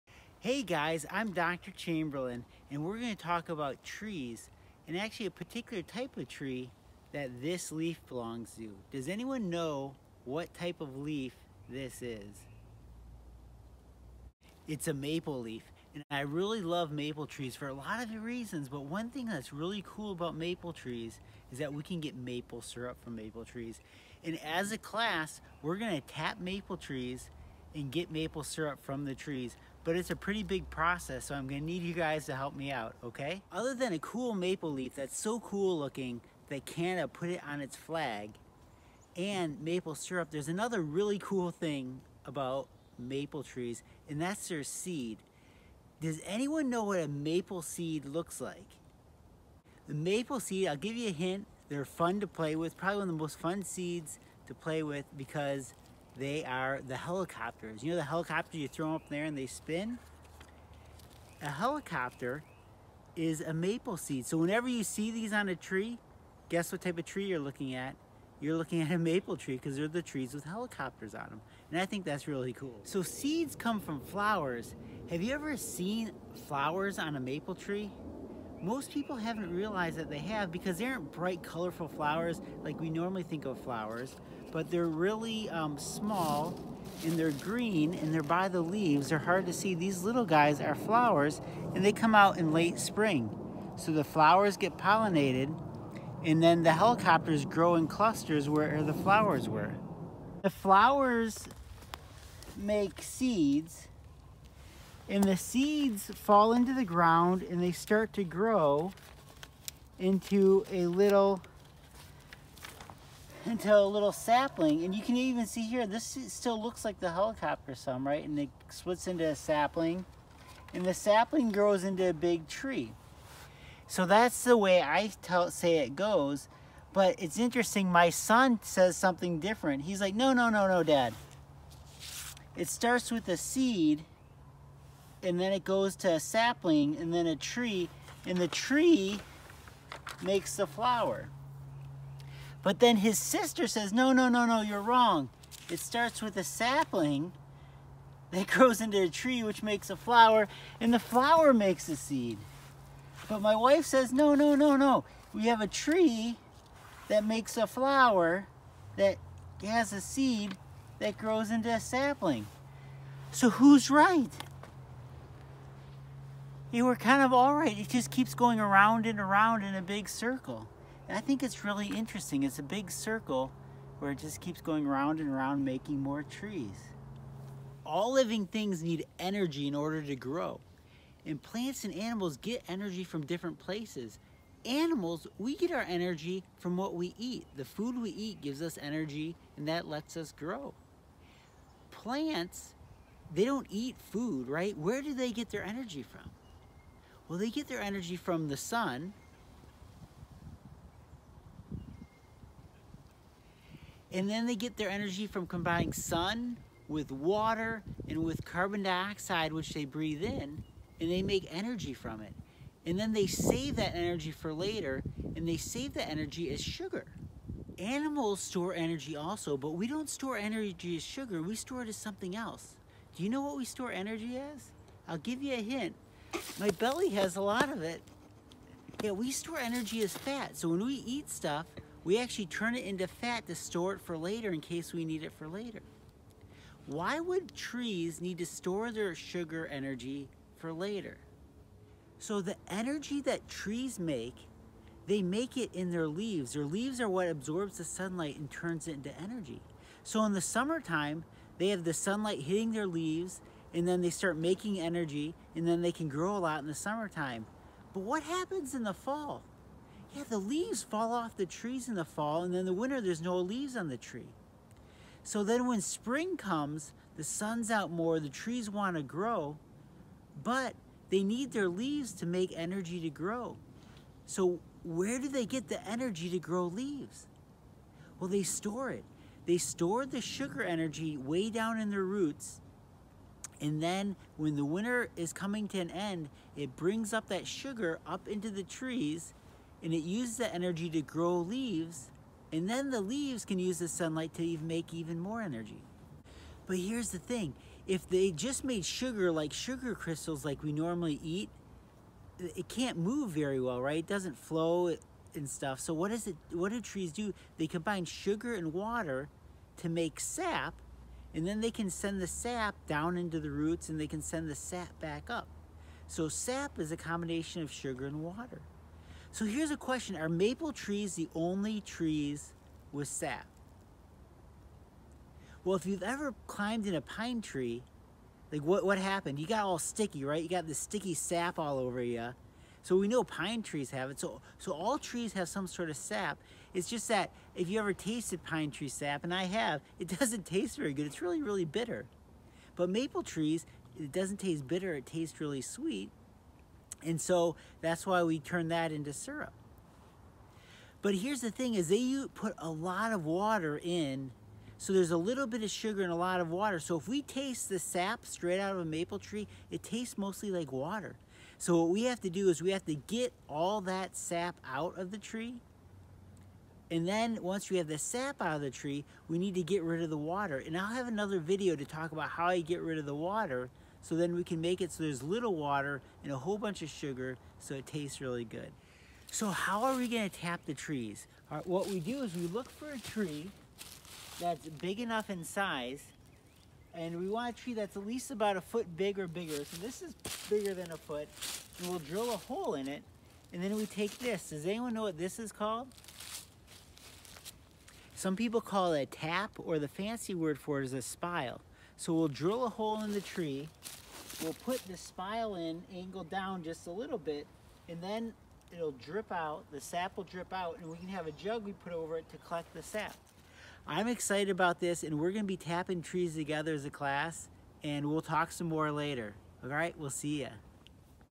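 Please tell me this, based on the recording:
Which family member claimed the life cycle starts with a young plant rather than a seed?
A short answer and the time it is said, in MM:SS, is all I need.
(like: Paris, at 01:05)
his sister, at 02:22.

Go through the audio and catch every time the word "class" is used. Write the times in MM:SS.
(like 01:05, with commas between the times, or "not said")
00:24, 06:56.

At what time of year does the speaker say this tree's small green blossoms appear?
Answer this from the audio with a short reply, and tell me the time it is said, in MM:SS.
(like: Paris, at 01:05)
late spring, at 01:32.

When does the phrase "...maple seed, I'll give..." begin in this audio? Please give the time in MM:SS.
00:49.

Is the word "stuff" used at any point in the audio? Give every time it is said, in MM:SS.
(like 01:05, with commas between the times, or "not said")
03:51, 05:05.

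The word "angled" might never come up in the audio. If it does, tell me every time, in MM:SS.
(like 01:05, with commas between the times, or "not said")
06:45.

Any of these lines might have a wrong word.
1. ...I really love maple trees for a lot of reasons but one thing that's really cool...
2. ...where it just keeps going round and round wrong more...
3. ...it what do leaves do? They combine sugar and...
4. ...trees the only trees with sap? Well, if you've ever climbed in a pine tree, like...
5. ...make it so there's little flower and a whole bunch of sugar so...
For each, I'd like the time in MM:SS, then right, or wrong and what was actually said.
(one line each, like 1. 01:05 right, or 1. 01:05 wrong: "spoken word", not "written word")
1. 00:16 right
2. 02:53 wrong: "making", not "wrong"
3. 05:06 wrong: "trees", not "leaves"
4. 05:20 right
5. 06:14 wrong: "water", not "flower".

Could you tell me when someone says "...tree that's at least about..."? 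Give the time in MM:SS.
06:27.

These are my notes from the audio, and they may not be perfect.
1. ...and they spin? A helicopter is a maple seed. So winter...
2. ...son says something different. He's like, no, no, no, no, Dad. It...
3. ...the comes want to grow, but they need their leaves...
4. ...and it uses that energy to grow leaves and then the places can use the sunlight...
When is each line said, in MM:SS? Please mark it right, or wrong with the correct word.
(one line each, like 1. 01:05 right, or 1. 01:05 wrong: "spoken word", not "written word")
1. 00:59 wrong: "whenever", not "winter"
2. 02:08 right
3. 04:28 wrong: "trees", not "comes"
4. 04:49 wrong: "leaves", not "places".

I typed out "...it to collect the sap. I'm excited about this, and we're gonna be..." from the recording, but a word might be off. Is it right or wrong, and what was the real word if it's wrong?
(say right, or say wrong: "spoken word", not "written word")
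right.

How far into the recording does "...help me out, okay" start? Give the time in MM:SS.
00:32.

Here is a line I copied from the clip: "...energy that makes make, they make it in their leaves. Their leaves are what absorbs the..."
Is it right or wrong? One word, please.
wrong.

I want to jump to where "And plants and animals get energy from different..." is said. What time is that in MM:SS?
03:01.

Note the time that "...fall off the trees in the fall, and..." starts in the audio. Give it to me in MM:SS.
04:20.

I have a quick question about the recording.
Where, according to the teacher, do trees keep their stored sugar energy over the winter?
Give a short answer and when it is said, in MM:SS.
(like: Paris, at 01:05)
in their roots, at 04:41.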